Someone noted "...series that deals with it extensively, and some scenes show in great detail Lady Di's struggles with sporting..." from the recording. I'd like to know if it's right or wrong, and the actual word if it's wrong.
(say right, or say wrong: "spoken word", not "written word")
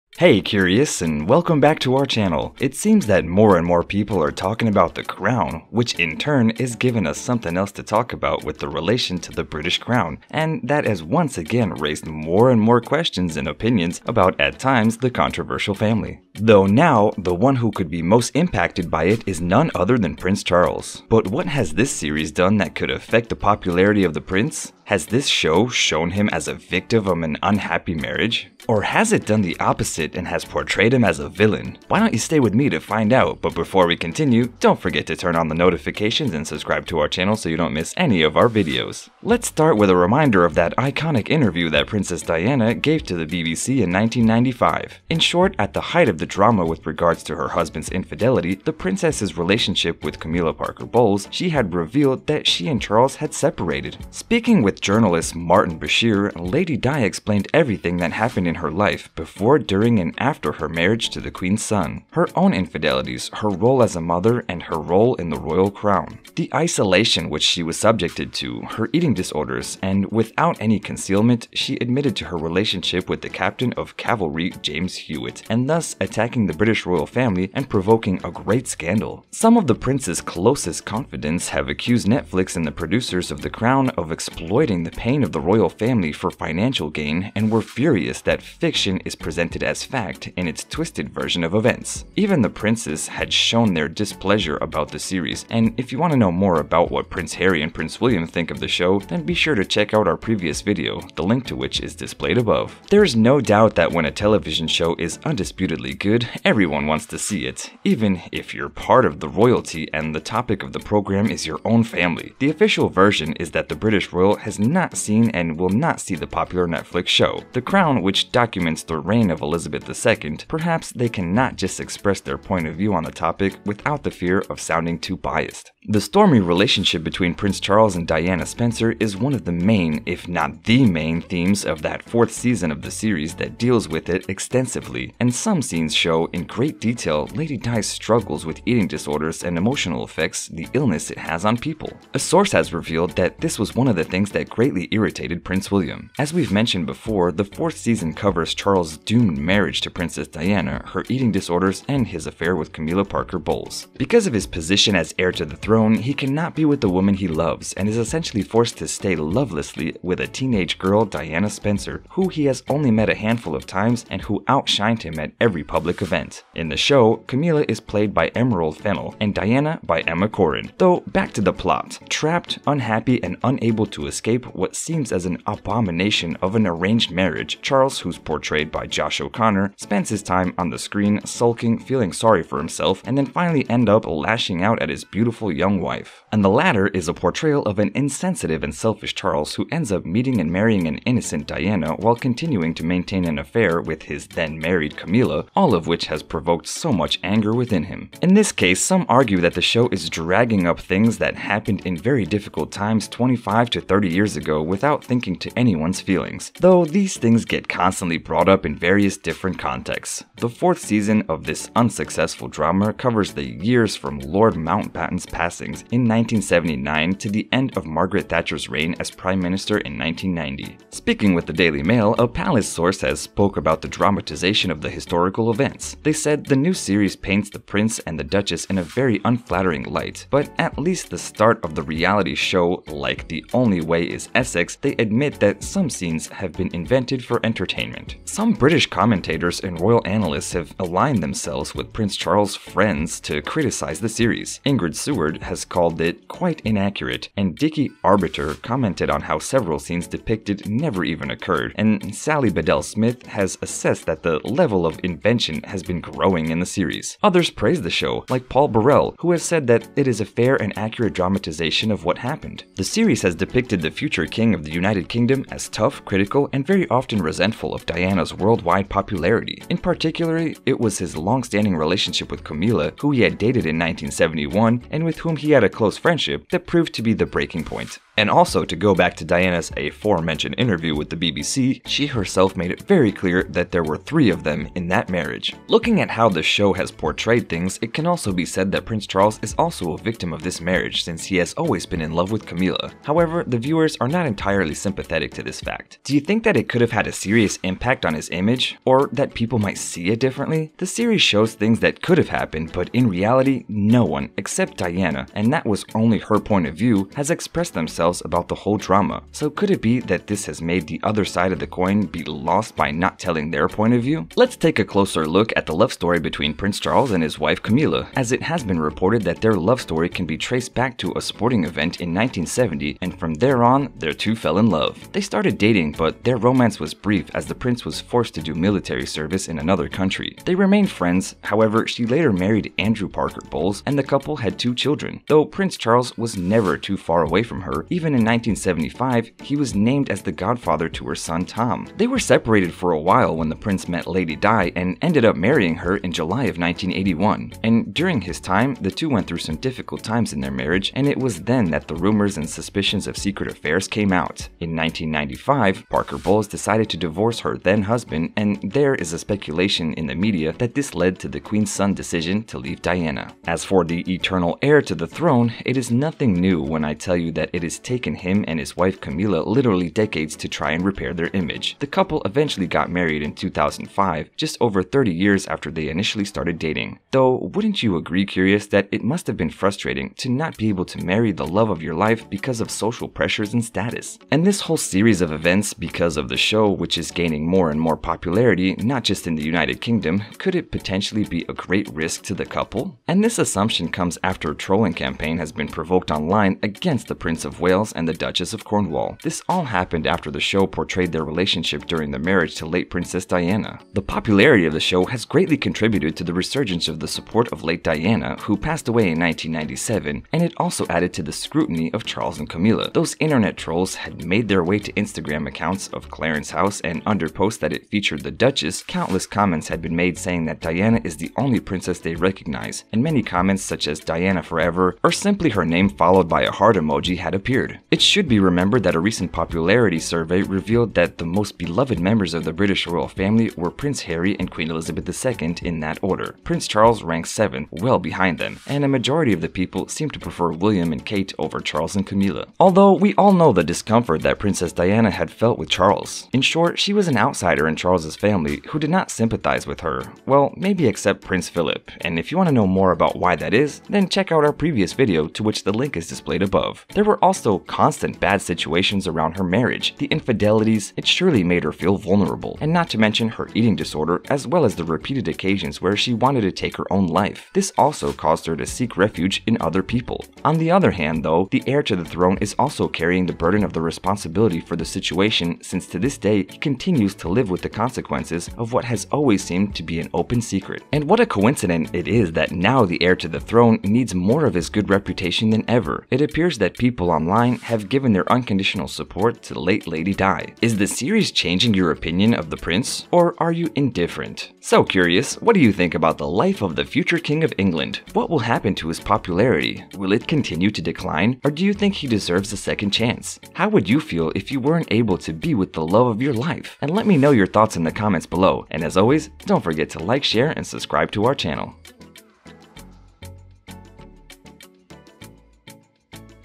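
wrong: "eating", not "sporting".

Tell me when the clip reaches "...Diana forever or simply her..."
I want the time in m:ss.
7:04.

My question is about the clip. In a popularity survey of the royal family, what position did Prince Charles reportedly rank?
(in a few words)
7th.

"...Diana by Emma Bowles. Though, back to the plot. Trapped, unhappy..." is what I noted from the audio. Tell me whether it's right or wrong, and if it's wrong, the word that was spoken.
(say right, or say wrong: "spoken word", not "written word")
wrong: "Corrin", not "Bowles".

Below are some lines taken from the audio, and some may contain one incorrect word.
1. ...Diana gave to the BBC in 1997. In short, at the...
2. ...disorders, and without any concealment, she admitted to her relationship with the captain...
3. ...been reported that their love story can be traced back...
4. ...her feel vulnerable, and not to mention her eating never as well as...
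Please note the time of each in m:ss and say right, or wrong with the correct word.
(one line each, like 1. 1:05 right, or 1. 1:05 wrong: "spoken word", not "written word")
1. 0:42 wrong: "1995", not "1997"
2. 1:09 right
3. 5:18 right
4. 7:41 wrong: "disorder", not "never".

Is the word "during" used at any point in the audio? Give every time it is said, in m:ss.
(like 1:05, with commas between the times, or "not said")
0:59, 5:47, 6:41.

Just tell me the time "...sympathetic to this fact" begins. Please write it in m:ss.
4:54.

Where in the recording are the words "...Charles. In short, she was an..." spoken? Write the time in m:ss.
7:25.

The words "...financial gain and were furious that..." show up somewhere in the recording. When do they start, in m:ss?
1:26.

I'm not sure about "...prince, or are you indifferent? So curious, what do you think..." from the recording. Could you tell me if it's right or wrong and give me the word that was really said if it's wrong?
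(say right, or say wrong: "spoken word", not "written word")
right.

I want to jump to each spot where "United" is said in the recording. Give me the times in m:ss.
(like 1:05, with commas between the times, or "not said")
4:24, 6:29.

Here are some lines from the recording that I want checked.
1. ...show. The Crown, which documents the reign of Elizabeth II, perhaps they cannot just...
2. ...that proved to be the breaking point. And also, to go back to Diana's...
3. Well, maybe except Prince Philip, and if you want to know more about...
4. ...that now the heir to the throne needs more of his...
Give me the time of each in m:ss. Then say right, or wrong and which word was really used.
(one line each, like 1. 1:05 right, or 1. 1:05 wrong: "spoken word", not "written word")
1. 1:57 right
2. 4:36 right
3. 7:30 right
4. 8:02 right.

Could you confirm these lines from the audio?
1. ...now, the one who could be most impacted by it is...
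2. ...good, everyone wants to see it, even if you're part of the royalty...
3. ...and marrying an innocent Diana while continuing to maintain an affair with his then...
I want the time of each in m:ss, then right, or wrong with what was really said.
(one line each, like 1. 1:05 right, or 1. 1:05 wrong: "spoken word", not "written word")
1. 0:16 right
2. 1:45 right
3. 3:10 right.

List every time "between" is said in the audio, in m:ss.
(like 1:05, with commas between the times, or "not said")
2:07, 5:16.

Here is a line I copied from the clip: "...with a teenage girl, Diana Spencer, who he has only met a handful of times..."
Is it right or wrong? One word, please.
right.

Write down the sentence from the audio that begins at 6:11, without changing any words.
The couple eventually got married in 2005, just over 30 years after they initially started dating.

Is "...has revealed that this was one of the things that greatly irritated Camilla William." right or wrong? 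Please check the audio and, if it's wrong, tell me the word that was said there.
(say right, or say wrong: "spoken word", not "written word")
wrong: "Prince", not "Camilla".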